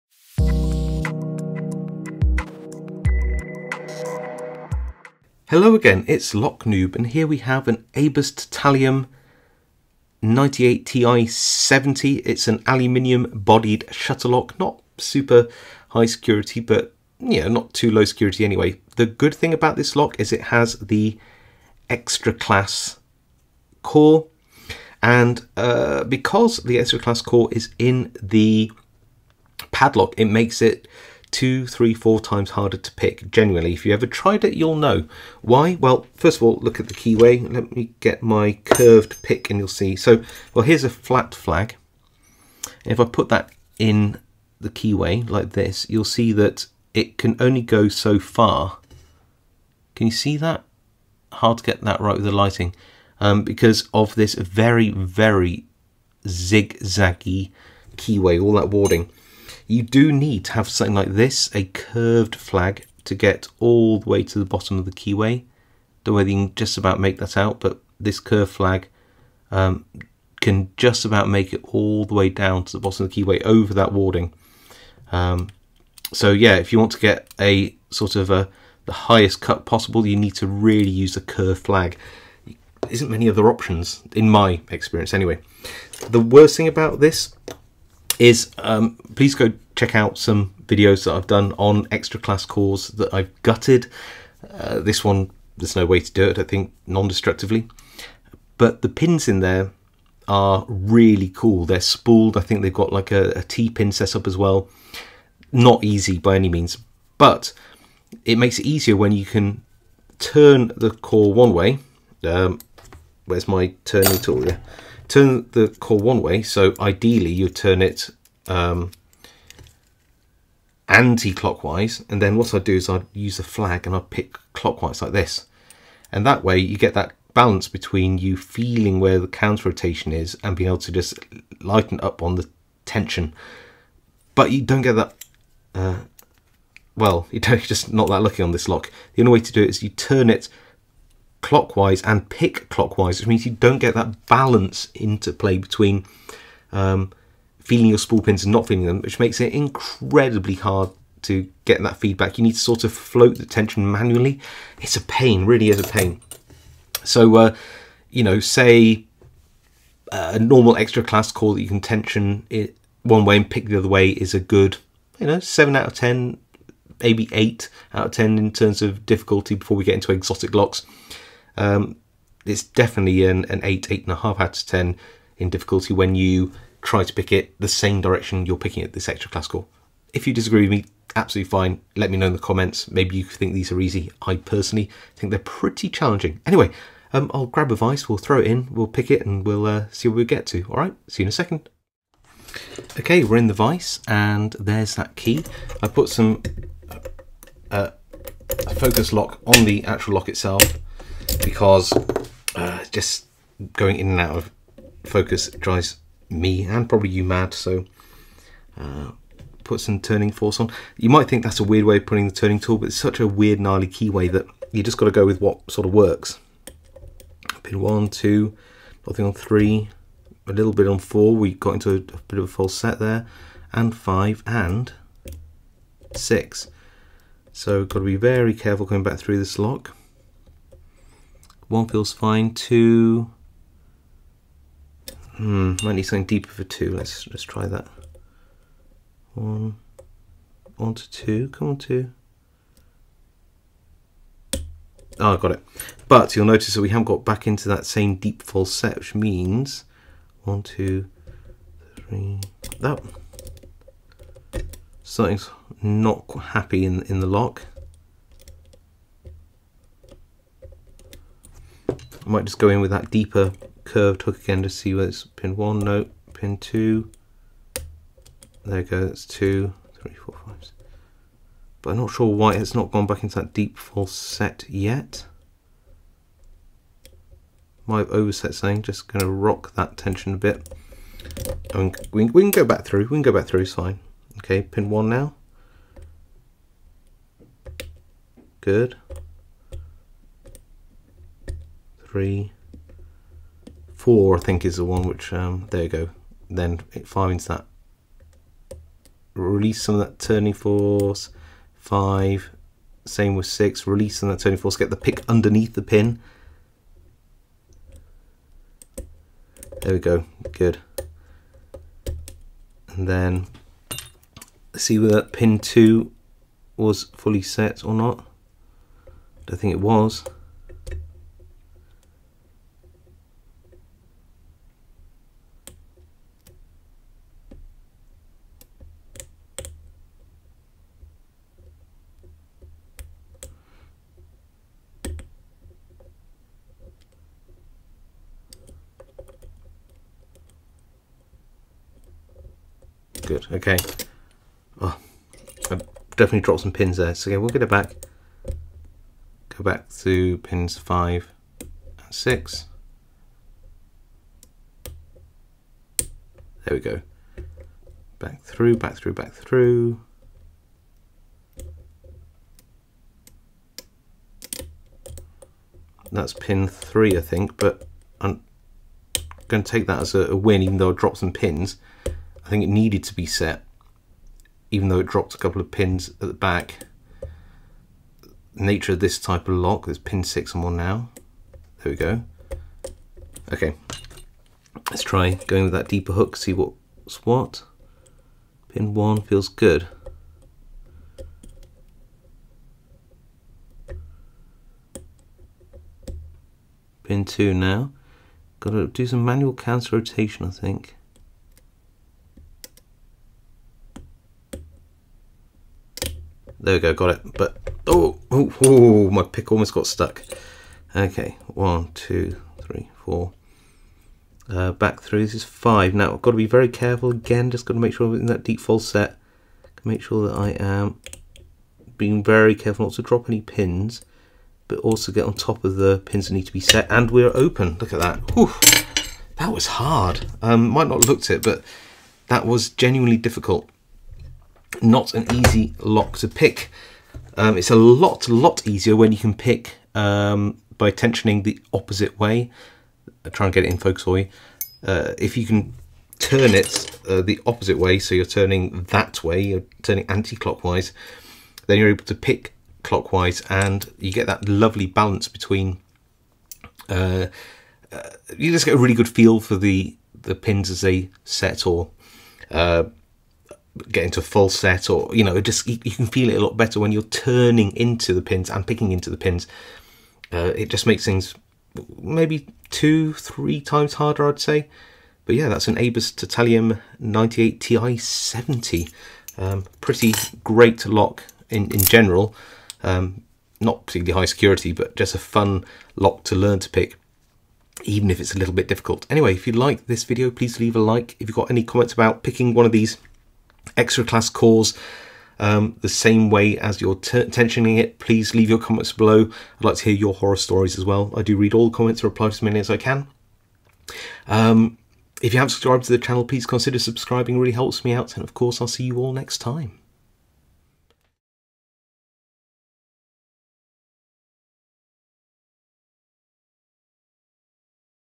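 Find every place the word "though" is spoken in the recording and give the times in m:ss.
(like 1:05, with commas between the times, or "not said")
6:10, 6:14.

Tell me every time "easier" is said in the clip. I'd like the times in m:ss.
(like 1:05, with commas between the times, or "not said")
1:48, 7:18.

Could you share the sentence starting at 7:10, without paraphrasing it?
Um, might not looked it, but that was genuinely difficult not an easy lock to pick.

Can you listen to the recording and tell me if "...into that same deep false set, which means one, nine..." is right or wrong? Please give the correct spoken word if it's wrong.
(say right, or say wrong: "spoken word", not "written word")
wrong: "two", not "nine".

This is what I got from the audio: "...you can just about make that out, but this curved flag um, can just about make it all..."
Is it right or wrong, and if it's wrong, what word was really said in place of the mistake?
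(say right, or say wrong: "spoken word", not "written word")
right.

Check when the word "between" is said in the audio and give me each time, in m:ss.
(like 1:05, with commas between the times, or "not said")
2:07, 2:25, 7:35.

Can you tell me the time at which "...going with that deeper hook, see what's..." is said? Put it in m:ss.
6:25.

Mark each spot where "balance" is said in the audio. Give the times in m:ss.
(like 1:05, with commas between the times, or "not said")
2:07, 2:24, 7:34.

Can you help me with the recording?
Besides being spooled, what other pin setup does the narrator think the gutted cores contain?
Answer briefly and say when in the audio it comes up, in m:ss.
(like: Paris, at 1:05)
T-pin, at 1:43.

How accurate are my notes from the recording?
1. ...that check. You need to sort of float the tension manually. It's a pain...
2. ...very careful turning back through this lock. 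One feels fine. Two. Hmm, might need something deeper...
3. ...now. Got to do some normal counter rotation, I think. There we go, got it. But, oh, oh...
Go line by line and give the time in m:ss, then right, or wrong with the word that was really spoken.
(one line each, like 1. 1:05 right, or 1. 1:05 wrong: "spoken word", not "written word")
1. 2:31 wrong: "feedback", not "check"
2. 3:48 wrong: "coming", not "turning"
3. 6:37 wrong: "manual", not "normal".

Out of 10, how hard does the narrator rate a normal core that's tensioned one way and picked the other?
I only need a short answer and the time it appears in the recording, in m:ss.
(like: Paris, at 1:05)
7, at 2:45.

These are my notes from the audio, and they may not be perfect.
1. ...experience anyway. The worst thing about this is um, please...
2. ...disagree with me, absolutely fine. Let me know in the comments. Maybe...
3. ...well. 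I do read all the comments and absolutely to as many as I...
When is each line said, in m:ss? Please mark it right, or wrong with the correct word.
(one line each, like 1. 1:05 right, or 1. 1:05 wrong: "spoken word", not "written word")
1. 1:24 right
2. 3:00 right
3. 8:20 wrong: "reply", not "absolutely".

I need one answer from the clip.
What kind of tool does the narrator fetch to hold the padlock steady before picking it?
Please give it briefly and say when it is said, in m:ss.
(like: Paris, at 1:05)
a vice, at 3:07.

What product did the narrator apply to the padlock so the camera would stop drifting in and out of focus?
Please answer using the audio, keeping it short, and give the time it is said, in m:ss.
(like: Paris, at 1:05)
focus lock, at 3:18.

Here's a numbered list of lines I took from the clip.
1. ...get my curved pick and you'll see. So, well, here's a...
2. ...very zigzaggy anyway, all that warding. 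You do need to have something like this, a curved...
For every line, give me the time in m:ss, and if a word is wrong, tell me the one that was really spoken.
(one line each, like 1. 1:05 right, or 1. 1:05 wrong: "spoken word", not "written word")
1. 0:38 right
2. 0:54 wrong: "keyway", not "anyway".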